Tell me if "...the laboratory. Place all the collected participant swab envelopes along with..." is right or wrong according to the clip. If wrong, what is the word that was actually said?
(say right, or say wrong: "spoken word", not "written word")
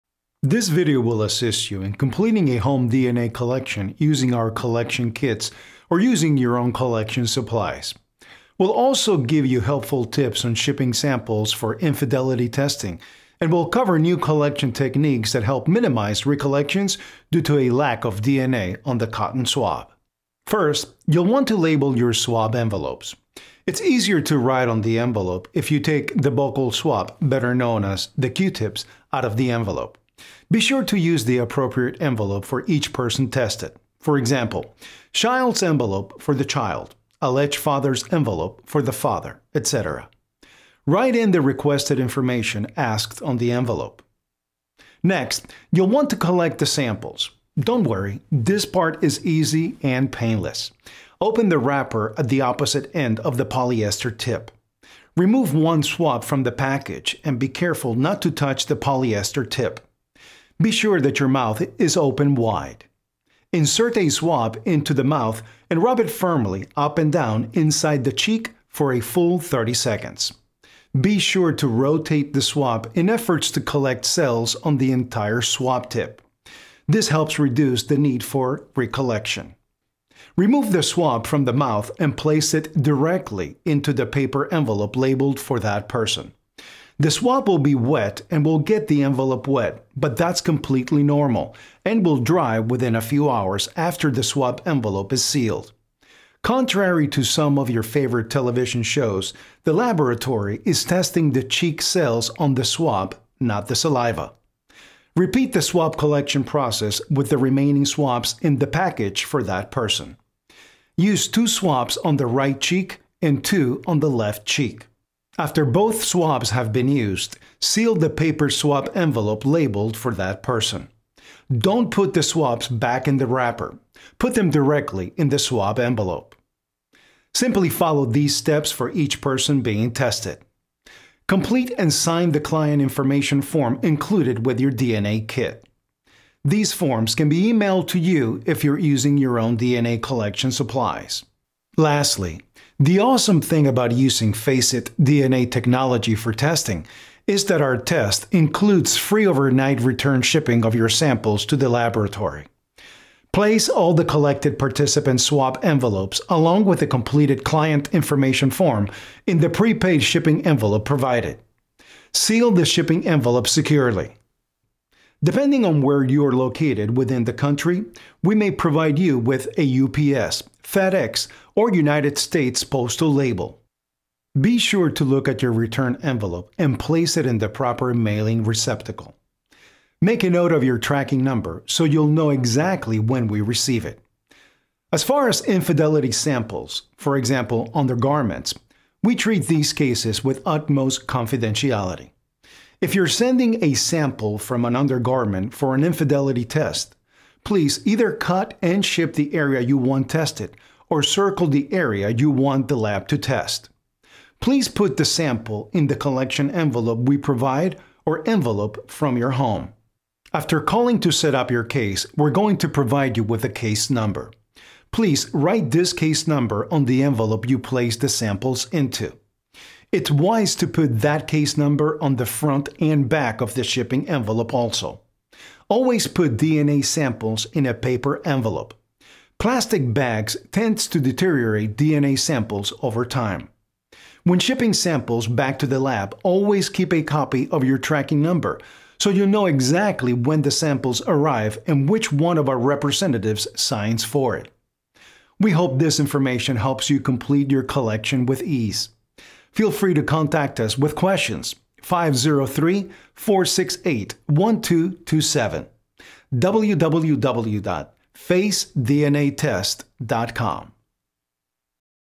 right.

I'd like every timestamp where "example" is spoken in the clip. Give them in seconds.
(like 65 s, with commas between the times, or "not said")
34 s, 187 s.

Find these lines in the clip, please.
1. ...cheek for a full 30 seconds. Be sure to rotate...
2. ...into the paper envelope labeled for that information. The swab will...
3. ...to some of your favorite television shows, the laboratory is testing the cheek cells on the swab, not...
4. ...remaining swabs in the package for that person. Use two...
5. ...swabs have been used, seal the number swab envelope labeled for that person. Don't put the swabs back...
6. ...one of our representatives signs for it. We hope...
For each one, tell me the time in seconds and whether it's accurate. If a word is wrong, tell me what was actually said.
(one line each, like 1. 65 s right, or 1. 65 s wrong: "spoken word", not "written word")
1. 68 s right
2. 83 s wrong: "person", not "information"
3. 97 s right
4. 107 s right
5. 116 s wrong: "paper", not "number"
6. 242 s right.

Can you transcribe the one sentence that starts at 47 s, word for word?
Don't worry, this part is easy and painless.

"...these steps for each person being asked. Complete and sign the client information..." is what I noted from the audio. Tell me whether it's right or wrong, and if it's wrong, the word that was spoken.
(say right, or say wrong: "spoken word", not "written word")
wrong: "tested", not "asked".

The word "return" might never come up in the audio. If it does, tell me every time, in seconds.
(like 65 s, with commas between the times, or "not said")
149 s, 175 s.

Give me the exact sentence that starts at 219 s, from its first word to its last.
It's wise to put that case number on the front and back of the shipping envelope also.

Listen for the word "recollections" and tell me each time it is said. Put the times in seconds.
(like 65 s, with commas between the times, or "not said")
16 s, 78 s.